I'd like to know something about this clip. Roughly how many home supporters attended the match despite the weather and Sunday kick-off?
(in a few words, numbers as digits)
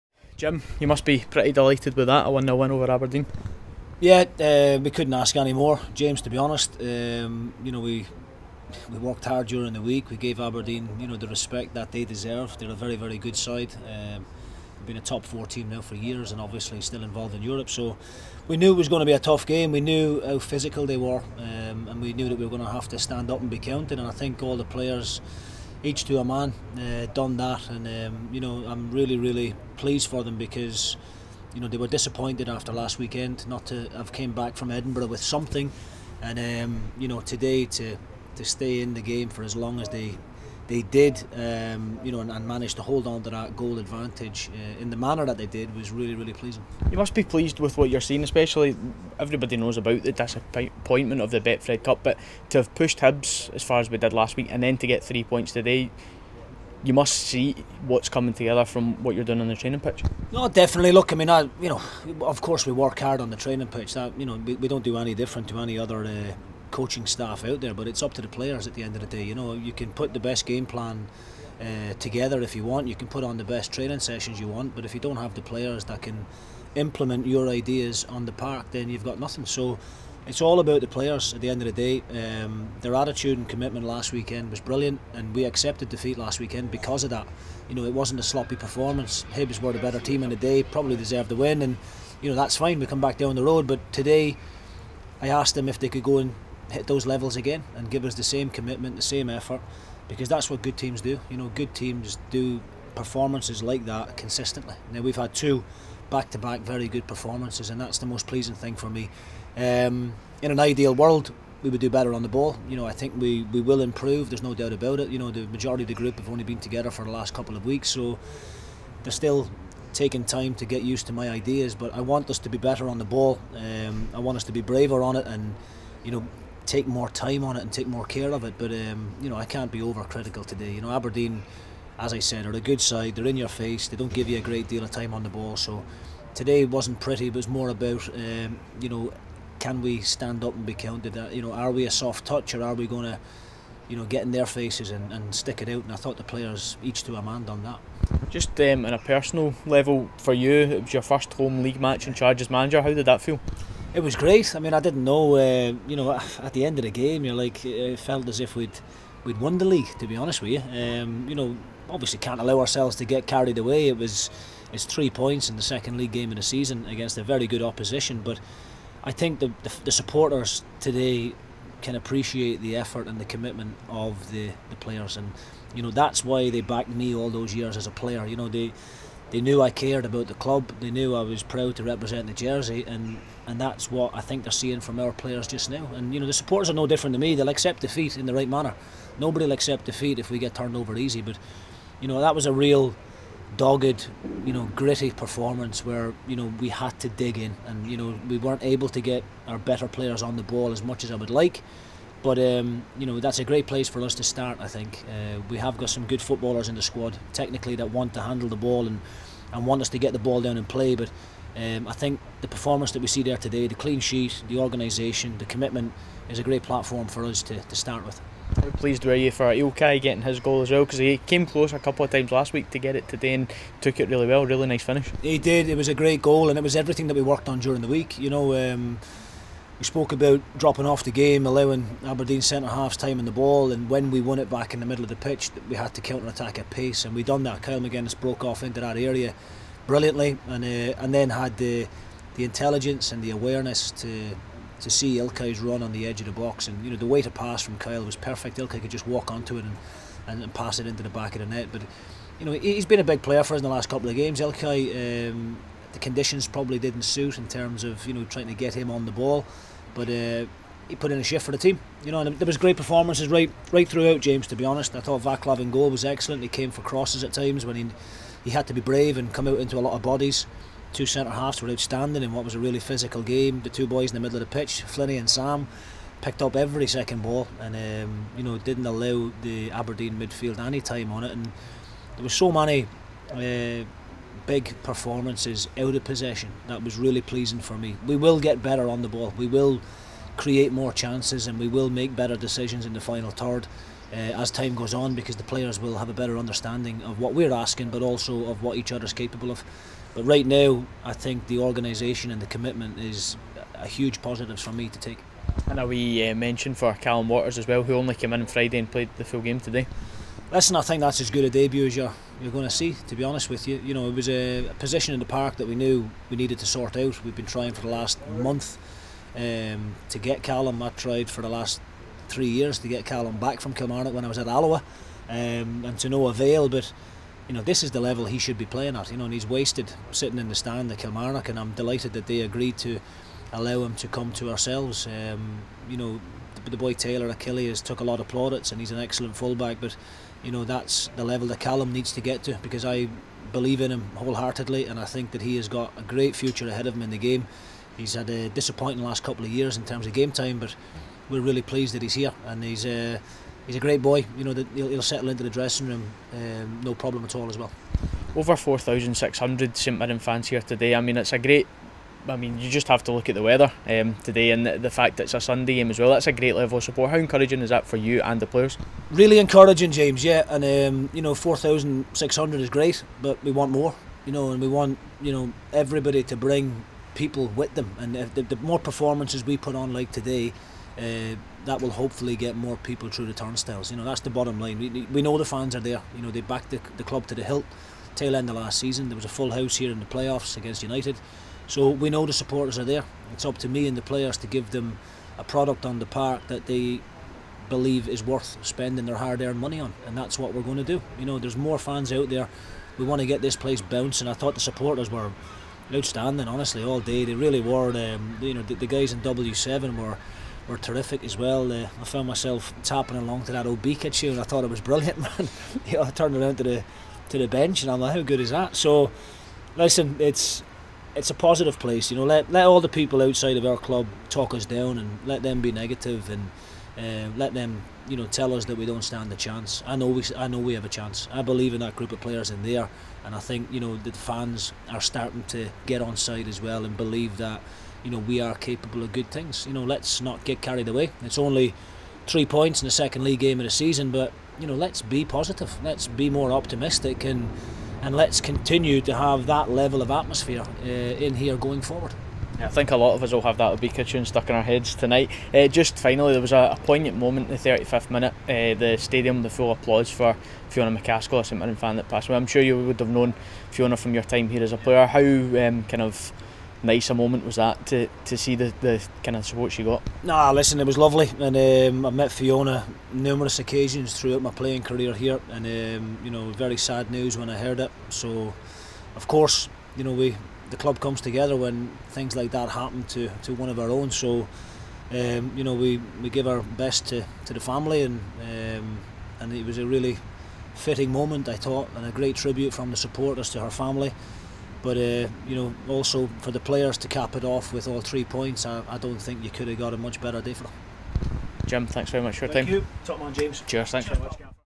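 4,600.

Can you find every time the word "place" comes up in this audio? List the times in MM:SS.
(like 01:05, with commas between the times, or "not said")
03:23, 06:43, 07:01.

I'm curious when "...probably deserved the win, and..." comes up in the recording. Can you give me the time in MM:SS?
01:30.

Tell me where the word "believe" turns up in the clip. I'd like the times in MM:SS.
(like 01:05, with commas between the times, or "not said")
05:43, 06:37, 07:11, 07:16.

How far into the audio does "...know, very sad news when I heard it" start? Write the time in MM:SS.
07:56.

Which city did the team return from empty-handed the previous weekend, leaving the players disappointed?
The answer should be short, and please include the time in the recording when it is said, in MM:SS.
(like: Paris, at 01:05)
Edinburgh, at 00:34.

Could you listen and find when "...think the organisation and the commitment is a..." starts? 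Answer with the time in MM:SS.
05:01.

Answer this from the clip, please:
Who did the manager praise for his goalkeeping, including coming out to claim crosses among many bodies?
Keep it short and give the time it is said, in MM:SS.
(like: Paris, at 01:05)
Vaclav, at 04:25.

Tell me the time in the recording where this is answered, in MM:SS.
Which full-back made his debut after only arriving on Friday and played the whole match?
05:06.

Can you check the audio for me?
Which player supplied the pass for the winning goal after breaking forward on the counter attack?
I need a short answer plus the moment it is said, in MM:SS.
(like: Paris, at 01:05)
Kyle Magennis, at 03:57.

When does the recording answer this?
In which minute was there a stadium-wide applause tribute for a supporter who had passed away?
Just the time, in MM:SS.
07:37.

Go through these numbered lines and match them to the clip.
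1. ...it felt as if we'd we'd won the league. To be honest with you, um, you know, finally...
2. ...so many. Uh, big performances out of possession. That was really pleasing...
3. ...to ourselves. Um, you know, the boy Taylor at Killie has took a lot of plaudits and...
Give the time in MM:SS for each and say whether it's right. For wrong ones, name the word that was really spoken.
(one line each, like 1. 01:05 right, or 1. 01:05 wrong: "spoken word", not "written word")
1. 02:37 wrong: "obviously", not "finally"
2. 04:42 right
3. 05:34 right.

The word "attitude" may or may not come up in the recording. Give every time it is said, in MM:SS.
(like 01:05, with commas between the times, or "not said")
01:22.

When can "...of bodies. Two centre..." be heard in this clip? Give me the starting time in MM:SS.
04:29.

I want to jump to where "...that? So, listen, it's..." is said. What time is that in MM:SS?
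06:58.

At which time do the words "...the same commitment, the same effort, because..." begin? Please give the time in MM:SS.
01:38.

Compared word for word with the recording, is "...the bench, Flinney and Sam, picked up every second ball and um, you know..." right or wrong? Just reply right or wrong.
wrong.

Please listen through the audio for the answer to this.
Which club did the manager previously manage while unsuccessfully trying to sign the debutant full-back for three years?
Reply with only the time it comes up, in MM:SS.
05:24.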